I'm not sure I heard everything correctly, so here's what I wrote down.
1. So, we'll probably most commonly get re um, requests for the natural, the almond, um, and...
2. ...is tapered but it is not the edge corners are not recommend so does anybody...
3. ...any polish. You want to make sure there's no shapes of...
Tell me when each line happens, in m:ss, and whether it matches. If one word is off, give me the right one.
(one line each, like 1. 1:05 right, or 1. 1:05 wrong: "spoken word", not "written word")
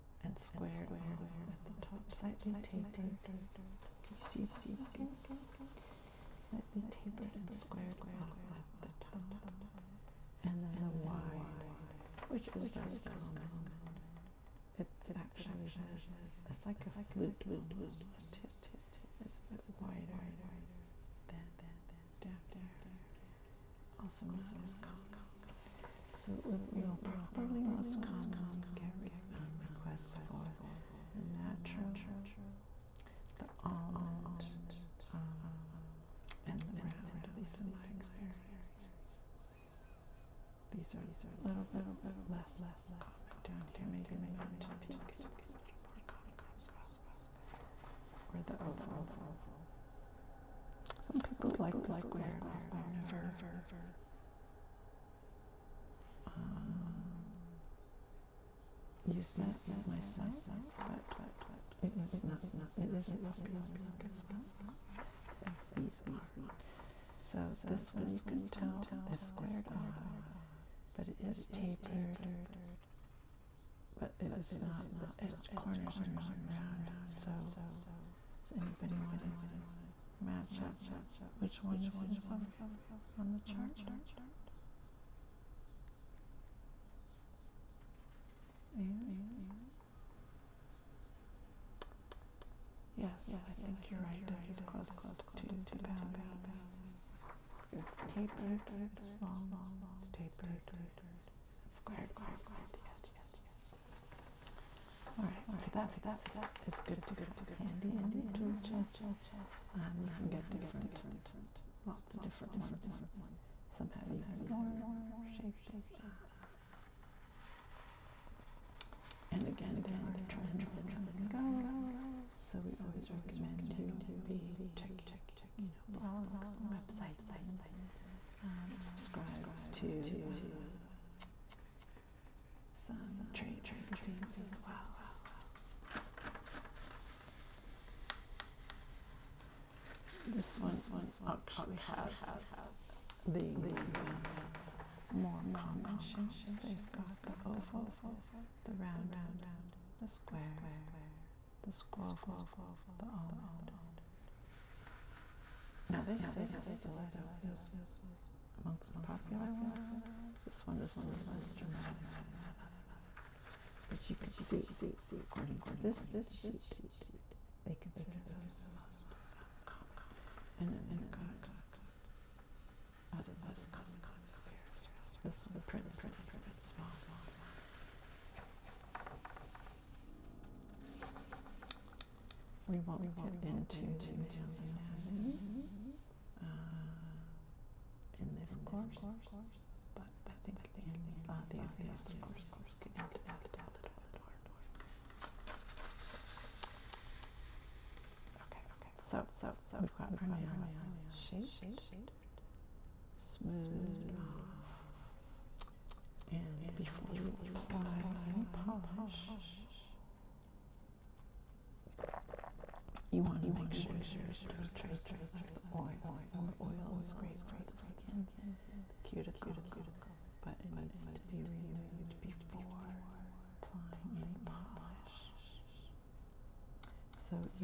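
1. 0:26 right
2. 1:11 wrong: "round", not "recommend"
3. 3:28 wrong: "traces", not "shapes".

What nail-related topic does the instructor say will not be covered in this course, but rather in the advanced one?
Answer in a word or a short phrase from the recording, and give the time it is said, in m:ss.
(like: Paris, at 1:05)
Nail anatomy, at 3:04.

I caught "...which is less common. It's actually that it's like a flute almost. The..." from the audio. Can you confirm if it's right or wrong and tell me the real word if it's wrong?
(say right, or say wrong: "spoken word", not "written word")
right.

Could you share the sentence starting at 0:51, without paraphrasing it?
Some people like the squared off.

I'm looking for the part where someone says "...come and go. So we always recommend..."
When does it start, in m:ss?
2:00.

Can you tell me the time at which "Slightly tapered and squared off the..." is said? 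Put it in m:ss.
0:06.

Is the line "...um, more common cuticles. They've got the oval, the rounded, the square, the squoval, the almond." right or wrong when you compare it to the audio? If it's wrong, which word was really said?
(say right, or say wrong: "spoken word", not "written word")
wrong: "shapes", not "cuticles".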